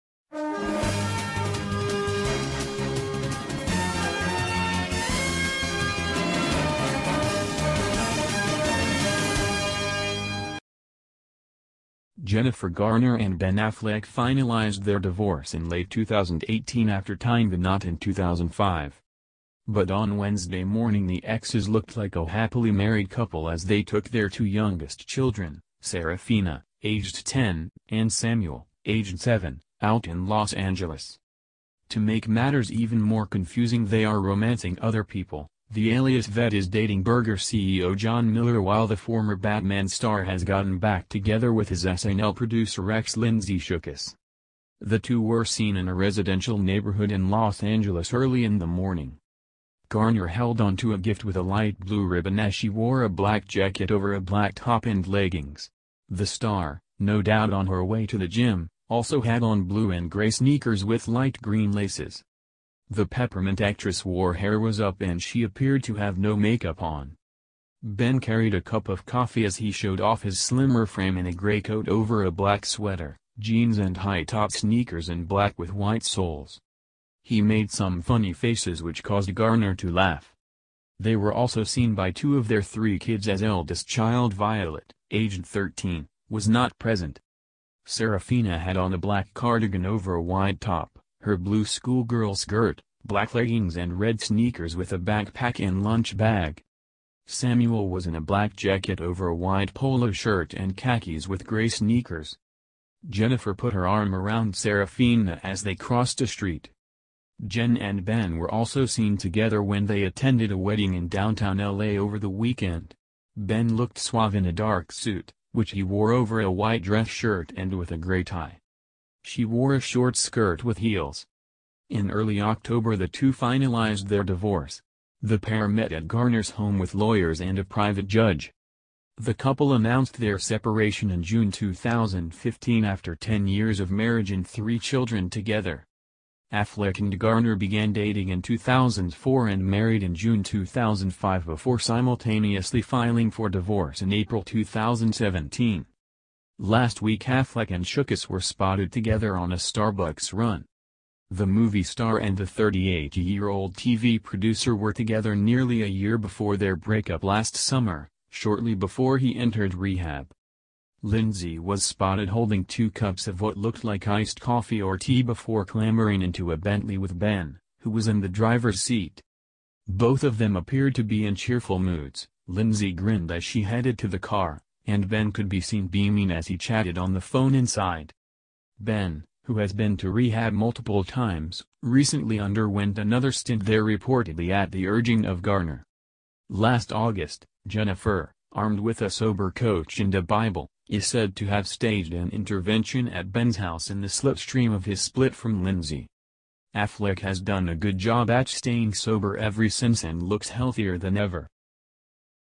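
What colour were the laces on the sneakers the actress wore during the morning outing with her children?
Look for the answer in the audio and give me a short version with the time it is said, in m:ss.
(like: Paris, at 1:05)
Light green, at 1:01.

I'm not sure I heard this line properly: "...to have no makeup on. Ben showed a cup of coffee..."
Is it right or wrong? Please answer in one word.
wrong.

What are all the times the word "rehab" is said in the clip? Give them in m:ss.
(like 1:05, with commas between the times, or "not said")
2:39, 3:00.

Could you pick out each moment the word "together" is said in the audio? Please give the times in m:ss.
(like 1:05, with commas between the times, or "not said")
0:41, 1:49, 2:15, 2:28, 2:34.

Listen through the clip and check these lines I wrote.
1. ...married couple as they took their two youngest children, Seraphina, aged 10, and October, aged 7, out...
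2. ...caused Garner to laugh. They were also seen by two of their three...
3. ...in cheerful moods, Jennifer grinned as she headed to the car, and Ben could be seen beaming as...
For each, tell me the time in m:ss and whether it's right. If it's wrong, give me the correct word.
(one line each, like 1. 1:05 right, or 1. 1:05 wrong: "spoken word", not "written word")
1. 0:22 wrong: "Samuel", not "October"
2. 1:19 right
3. 2:51 wrong: "Lindsay", not "Jennifer".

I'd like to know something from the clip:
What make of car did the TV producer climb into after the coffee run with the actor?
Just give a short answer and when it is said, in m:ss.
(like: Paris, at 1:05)
Bentley, at 2:46.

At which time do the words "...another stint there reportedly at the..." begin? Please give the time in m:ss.
3:02.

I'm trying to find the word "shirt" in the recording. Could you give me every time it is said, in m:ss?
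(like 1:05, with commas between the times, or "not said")
1:40, 1:57.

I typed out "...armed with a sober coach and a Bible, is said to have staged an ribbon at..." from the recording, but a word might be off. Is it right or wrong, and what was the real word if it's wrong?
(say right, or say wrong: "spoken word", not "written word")
wrong: "intervention", not "ribbon".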